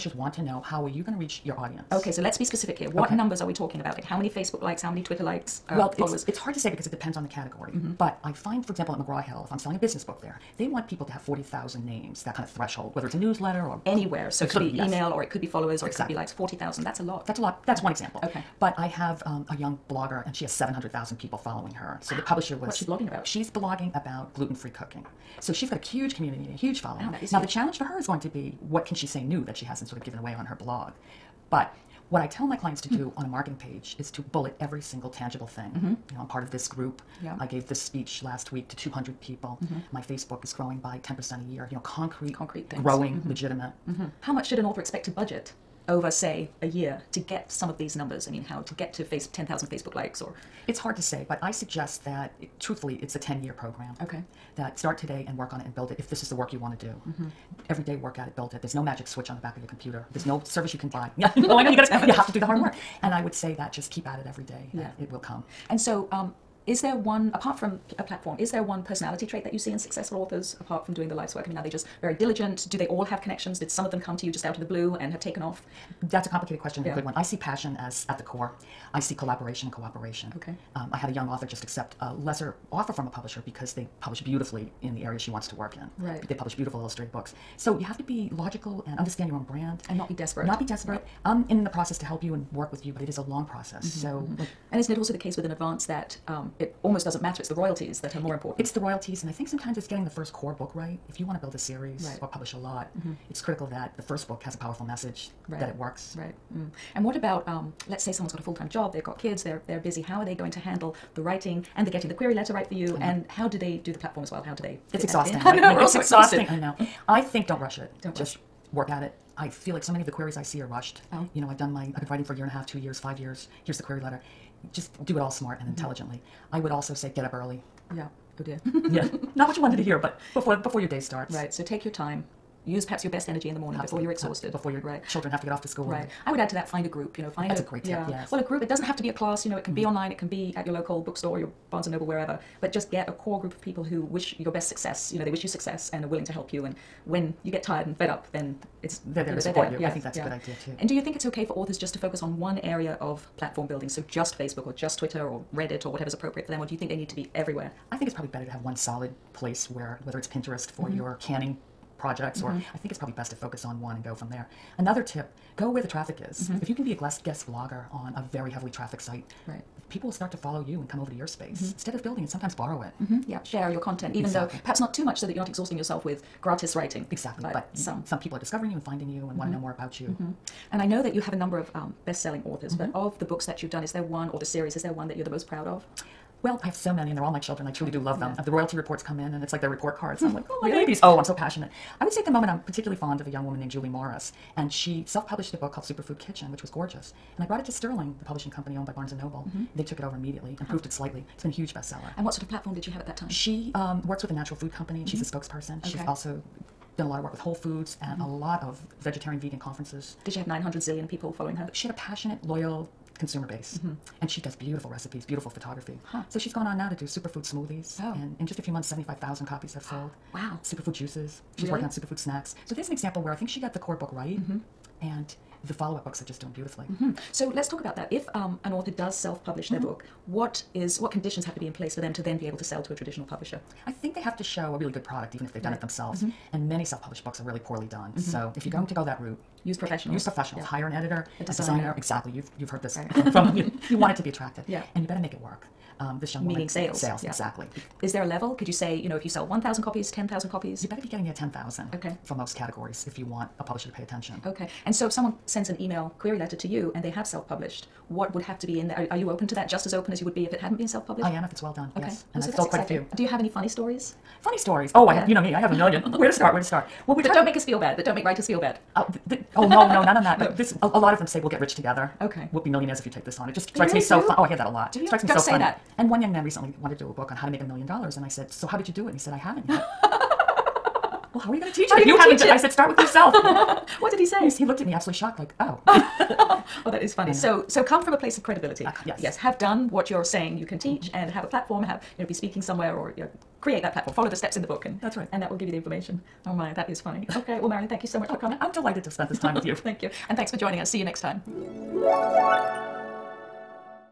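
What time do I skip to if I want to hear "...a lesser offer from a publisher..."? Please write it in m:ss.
1:22.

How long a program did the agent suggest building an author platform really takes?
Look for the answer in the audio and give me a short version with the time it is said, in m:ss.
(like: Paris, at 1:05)
10 years, at 0:53.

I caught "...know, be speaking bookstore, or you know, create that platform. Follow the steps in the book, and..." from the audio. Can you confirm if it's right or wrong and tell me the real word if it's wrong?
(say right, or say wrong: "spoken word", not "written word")
wrong: "somewhere", not "bookstore".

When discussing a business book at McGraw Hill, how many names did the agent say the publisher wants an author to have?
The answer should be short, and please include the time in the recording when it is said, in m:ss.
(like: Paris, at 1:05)
40,000, at 0:11.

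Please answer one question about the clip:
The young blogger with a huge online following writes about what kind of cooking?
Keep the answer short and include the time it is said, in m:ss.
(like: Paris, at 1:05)
Gluten-free cooking, at 0:24.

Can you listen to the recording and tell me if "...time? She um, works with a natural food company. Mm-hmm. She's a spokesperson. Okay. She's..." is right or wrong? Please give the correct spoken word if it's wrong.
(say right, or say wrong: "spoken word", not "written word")
right.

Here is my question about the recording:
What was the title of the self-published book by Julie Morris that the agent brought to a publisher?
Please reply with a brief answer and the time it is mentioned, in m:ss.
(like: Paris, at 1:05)
Superfood Kitchen, at 3:15.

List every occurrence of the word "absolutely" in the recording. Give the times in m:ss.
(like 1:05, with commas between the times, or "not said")
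2:13, 4:44.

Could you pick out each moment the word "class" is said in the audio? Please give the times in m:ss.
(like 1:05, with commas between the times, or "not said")
2:19.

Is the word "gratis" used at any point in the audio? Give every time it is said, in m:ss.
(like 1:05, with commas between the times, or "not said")
2:56.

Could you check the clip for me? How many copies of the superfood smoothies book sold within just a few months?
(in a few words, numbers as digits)
75,000.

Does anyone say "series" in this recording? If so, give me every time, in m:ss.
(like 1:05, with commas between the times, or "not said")
1:41, 3:04.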